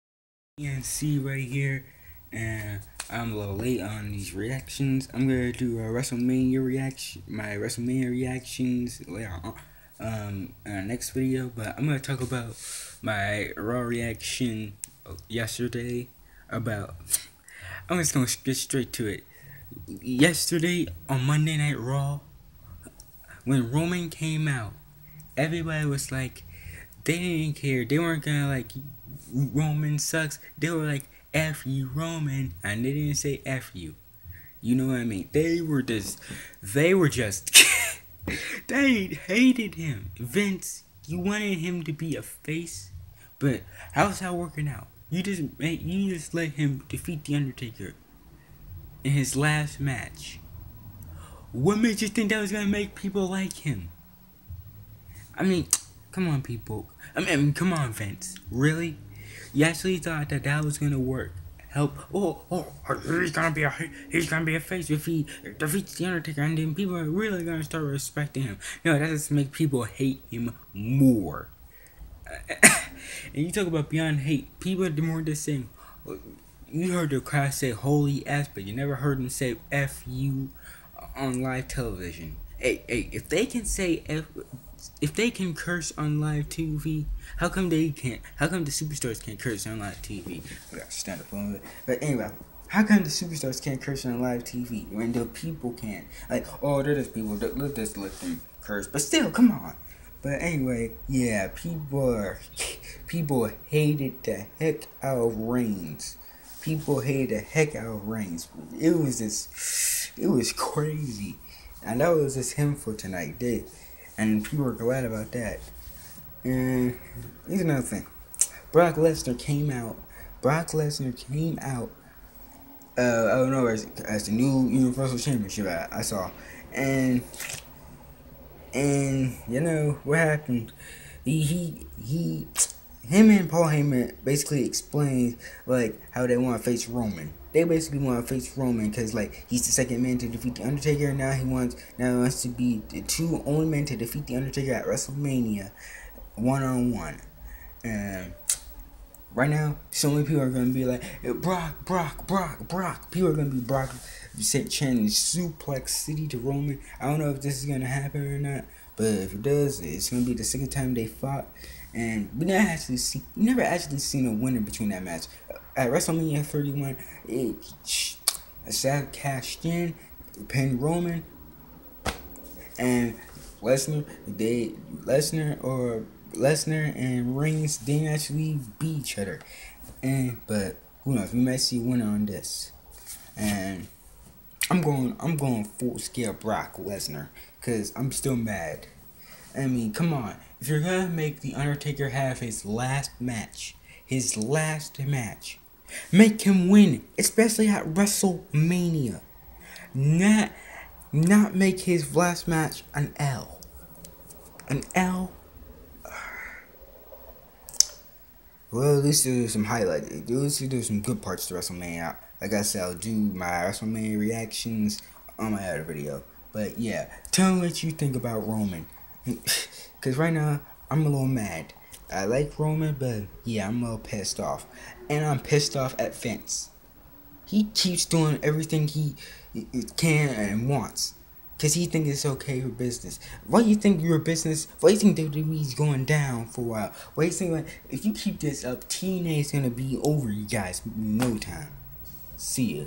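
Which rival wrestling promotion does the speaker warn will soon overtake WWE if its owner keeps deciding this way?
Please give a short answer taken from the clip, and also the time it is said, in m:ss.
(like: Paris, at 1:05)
TNA, at 3:58.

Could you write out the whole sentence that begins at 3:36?
But yeah, tell me what you think about Roman.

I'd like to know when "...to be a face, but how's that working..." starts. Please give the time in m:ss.
0:41.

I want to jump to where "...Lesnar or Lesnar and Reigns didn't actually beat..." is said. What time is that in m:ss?
2:54.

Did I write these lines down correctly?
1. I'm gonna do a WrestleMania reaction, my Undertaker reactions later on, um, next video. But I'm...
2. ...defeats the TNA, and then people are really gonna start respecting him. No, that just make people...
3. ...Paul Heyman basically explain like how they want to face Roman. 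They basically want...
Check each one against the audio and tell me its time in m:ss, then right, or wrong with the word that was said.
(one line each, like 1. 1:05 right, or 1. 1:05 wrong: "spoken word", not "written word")
1. 0:05 wrong: "WrestleMania", not "Undertaker"
2. 1:05 wrong: "Undertaker", not "TNA"
3. 2:13 right.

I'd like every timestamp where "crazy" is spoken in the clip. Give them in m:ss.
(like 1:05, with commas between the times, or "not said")
1:50.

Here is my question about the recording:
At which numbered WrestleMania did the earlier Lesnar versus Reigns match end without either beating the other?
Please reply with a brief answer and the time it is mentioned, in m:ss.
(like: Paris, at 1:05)
WrestleMania 31, at 2:45.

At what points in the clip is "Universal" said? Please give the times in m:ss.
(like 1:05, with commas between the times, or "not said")
2:04.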